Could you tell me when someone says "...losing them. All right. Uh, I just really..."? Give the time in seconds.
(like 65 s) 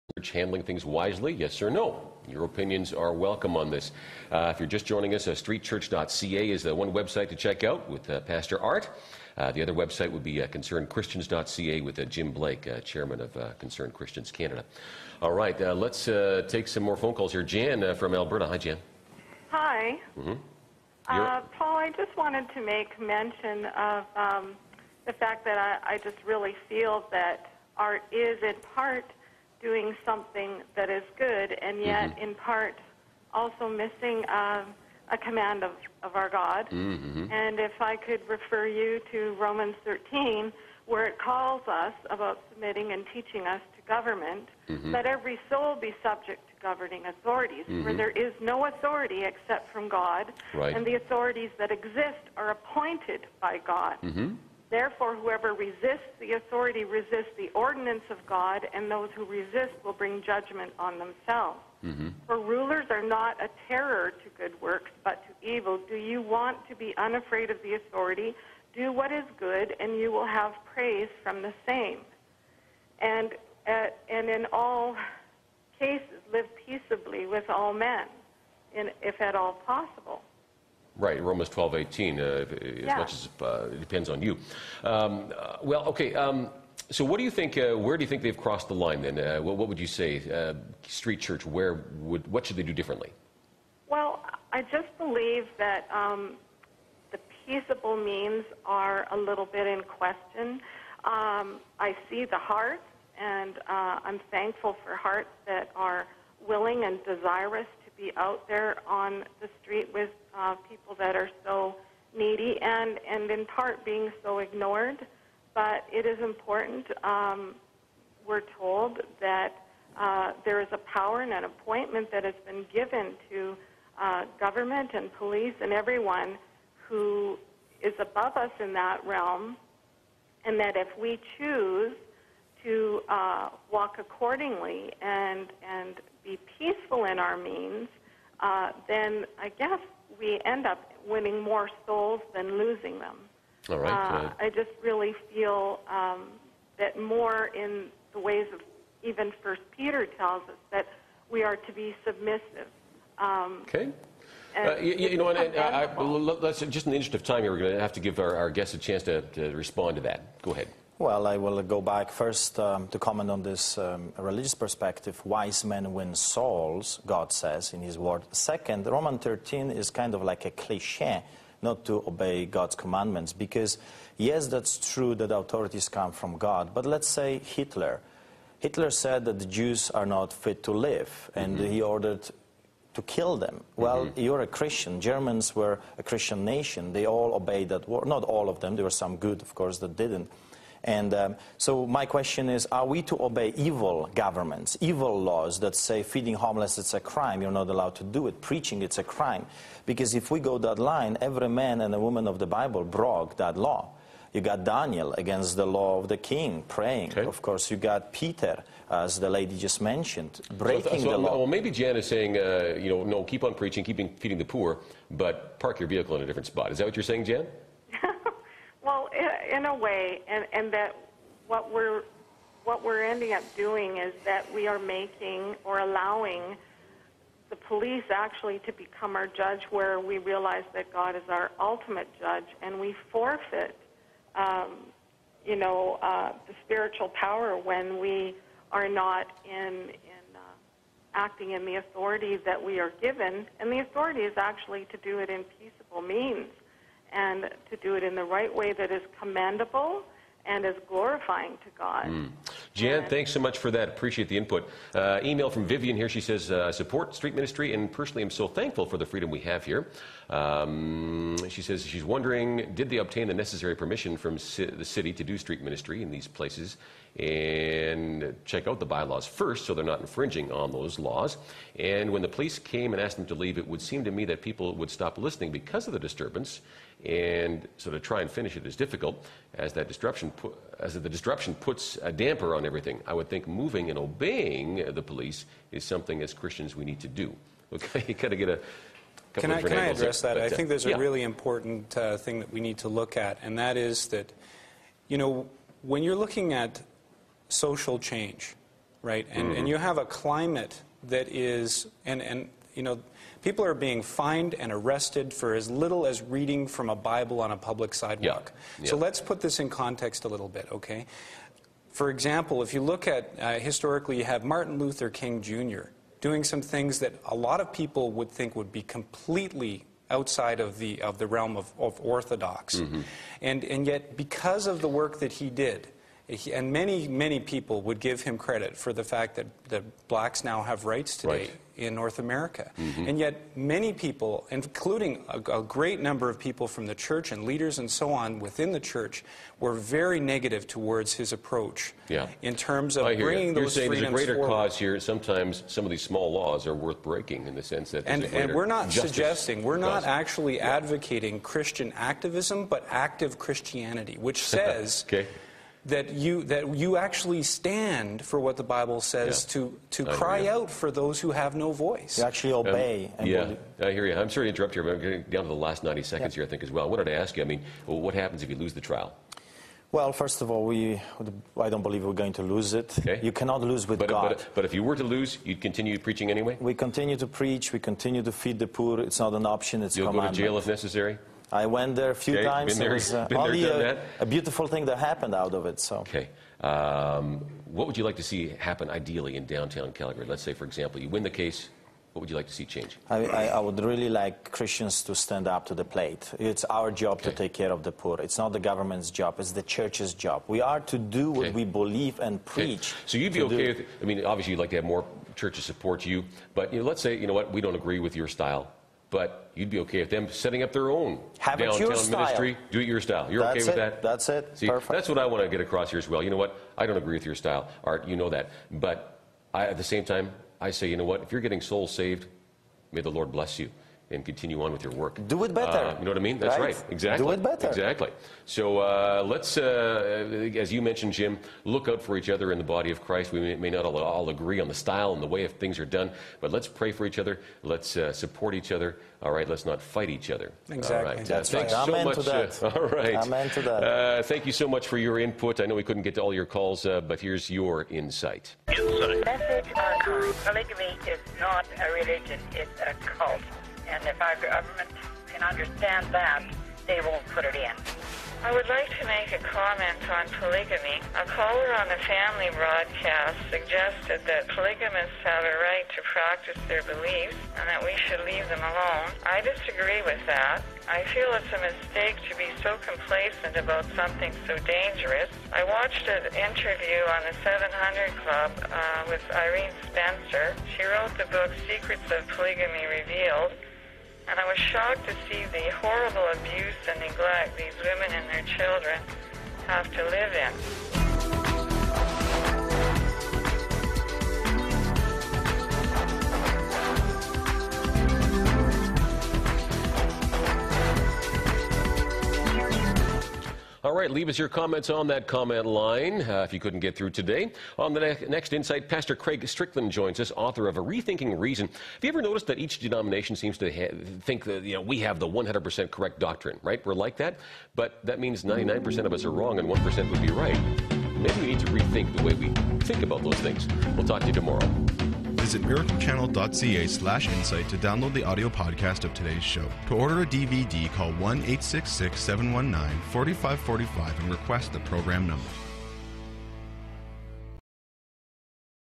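142 s.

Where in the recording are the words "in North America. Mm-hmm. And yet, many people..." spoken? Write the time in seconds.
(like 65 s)
331 s.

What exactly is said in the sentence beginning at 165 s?
Wise men win souls, God says in His Word.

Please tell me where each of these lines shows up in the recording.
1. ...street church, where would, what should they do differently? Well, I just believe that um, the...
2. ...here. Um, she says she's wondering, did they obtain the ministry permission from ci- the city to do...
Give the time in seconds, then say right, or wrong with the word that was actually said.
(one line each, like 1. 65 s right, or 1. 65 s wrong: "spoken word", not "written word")
1. 90 s right
2. 259 s wrong: "necessary", not "ministry".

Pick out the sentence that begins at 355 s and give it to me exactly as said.
okay that you that you actually stand for what the Bible says yeah.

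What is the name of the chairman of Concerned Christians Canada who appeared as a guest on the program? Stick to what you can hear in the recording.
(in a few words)
Jim Blake.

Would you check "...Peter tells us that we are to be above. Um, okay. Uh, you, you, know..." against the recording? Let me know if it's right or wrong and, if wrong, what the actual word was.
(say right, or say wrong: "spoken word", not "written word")
wrong: "submissive", not "above".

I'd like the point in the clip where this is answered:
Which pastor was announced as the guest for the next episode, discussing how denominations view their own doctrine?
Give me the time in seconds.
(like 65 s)
509 s.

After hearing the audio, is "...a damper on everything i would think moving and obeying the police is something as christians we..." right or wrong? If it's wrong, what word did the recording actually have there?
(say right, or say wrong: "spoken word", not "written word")
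right.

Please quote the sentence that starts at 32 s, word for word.
in part also missing uh, a command of, of our God.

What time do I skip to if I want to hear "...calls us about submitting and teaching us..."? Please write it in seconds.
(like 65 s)
41 s.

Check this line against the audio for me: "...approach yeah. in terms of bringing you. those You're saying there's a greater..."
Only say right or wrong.
right.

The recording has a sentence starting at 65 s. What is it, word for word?
Do you want to be unafraid of the authority?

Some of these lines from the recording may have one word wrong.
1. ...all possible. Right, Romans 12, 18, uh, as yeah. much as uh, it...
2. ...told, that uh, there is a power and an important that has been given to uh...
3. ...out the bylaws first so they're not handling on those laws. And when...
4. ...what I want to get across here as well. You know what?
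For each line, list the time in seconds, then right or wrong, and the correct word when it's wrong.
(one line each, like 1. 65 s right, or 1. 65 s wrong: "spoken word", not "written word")
1. 79 s right
2. 118 s wrong: "appointment", not "important"
3. 268 s wrong: "infringing", not "handling"
4. 415 s right.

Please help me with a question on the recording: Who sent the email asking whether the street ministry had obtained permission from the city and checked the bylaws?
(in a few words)
Vivian.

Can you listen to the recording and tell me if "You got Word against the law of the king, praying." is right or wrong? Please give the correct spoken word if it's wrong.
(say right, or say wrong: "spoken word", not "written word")
wrong: "Daniel", not "Word".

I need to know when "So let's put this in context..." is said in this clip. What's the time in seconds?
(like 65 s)
308 s.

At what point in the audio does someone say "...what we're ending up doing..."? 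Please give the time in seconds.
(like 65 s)
222 s.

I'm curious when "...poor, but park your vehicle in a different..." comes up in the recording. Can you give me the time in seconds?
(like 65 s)
214 s.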